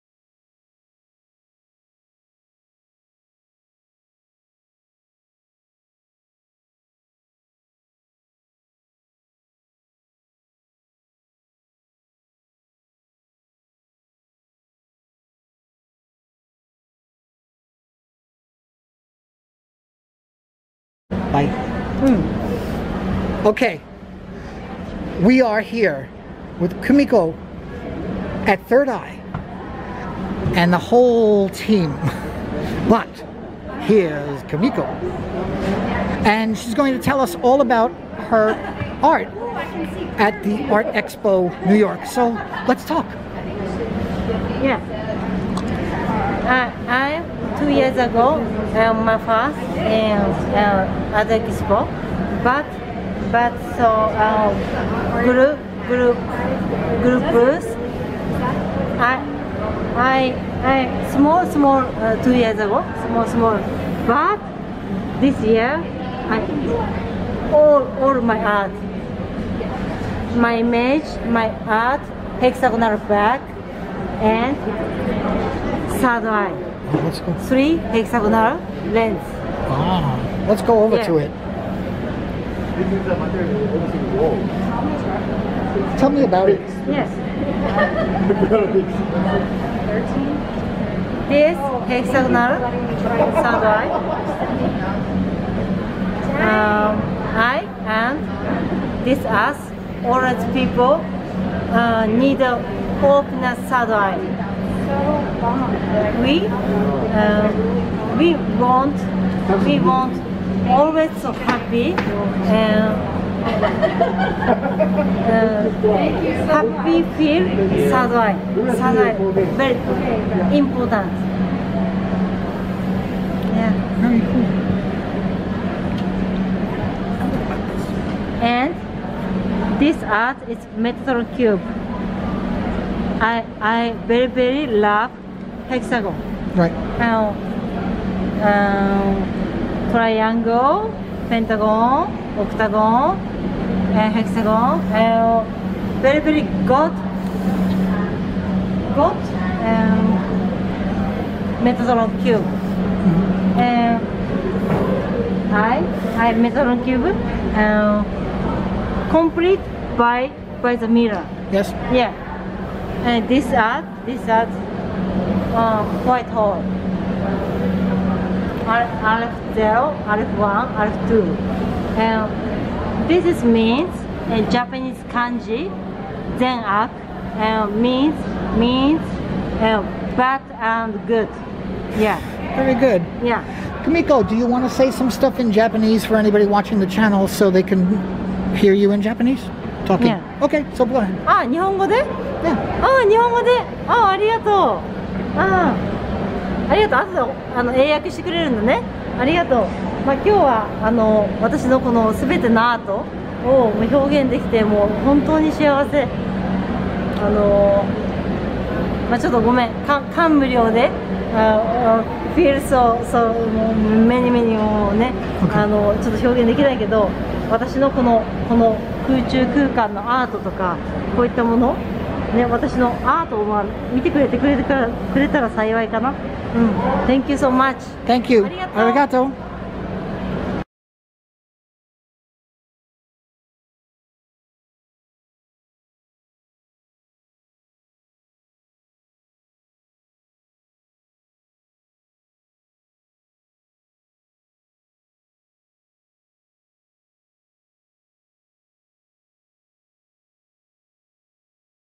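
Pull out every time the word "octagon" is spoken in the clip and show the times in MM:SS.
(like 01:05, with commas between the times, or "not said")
02:22.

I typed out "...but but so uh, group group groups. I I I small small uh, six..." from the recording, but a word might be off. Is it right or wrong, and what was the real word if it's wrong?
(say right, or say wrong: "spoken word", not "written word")
wrong: "two", not "six".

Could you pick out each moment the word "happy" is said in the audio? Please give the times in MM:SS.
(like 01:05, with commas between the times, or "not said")
01:51, 01:56.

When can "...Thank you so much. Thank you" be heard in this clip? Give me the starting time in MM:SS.
03:47.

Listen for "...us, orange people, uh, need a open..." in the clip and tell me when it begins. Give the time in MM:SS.
01:39.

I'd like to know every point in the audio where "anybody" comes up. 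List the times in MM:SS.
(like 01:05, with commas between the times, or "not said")
03:06.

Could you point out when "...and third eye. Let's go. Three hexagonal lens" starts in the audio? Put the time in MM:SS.
01:14.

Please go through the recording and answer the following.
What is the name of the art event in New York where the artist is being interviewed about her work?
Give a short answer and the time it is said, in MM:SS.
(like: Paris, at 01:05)
Artexpo New York, at 00:40.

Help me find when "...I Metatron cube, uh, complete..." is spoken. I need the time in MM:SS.
02:36.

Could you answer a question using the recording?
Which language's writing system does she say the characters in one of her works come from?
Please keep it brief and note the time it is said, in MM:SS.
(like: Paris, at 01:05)
Japanese kanji, at 02:54.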